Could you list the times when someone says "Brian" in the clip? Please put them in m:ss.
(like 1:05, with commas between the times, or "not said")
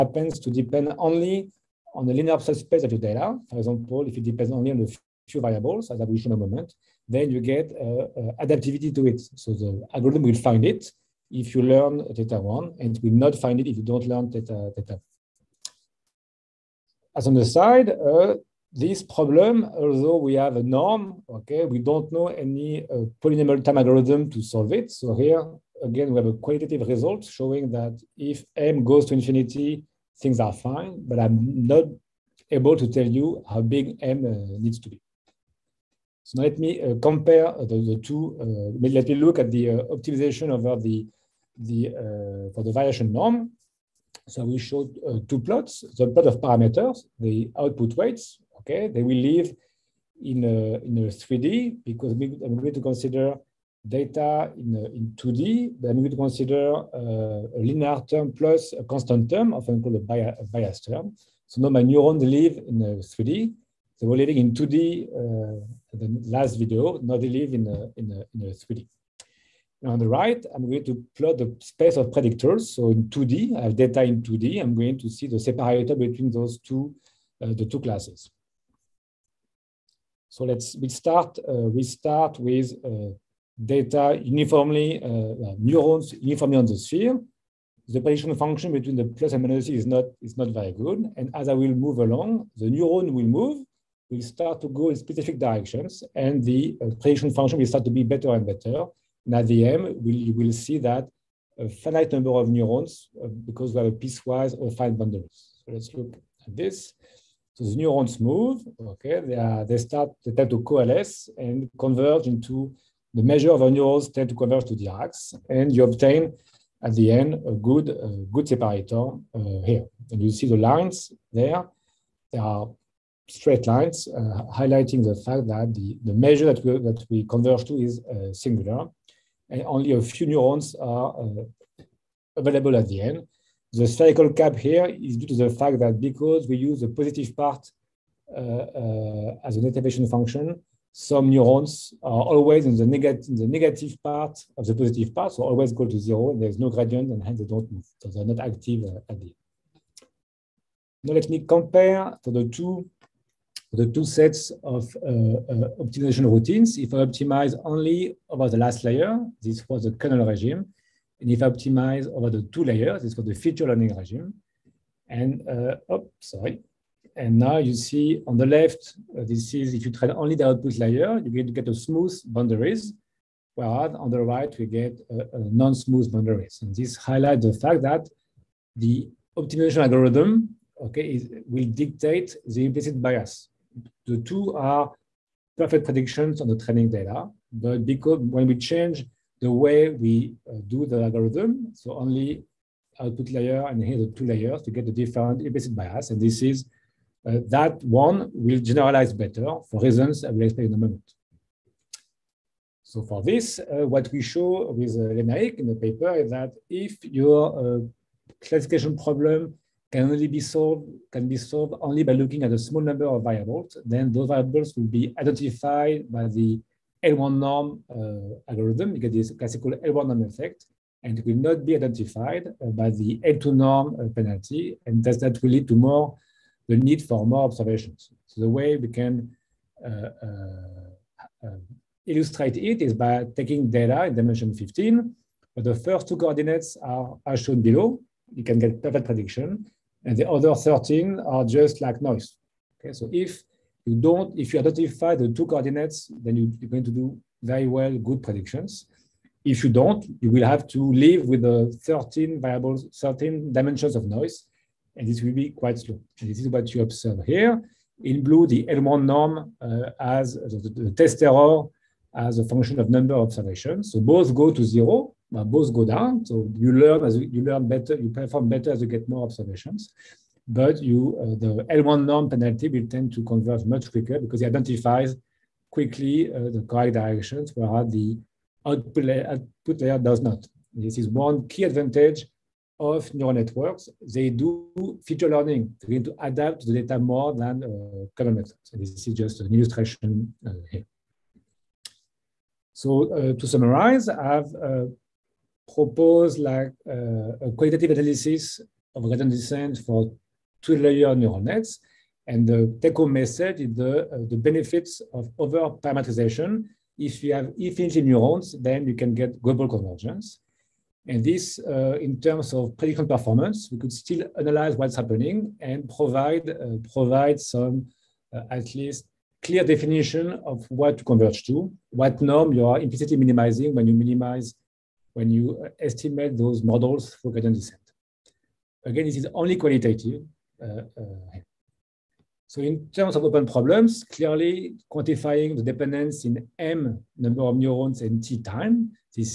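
not said.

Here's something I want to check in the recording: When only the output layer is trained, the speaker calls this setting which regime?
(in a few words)
kernel regime.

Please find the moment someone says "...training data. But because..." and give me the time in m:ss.
3:06.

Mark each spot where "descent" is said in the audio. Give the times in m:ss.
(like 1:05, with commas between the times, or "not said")
4:59, 5:27.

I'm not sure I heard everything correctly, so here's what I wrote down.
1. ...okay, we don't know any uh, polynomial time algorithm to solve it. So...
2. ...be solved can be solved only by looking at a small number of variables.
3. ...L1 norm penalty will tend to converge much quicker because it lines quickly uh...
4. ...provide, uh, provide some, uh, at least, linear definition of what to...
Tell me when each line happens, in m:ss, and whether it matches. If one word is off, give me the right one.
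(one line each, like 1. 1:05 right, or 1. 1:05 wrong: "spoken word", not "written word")
1. 0:21 right
2. 3:30 right
3. 4:31 wrong: "identifies", not "lines"
4. 5:15 wrong: "clear", not "linear".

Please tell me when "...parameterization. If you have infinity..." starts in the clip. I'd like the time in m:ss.
5:05.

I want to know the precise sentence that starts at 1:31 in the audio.
And as I will move along, the neuron will move.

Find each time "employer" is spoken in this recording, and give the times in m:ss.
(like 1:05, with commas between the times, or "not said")
not said.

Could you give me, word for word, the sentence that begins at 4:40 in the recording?
This is one key advantage of neural networks.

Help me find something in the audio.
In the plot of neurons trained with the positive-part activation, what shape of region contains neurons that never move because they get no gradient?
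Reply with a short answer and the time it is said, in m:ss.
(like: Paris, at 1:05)
spherical cap, at 2:13.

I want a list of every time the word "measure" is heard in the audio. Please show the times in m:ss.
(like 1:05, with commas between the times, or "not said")
1:53, 2:06.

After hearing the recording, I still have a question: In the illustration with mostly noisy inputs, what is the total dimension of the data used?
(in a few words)
15.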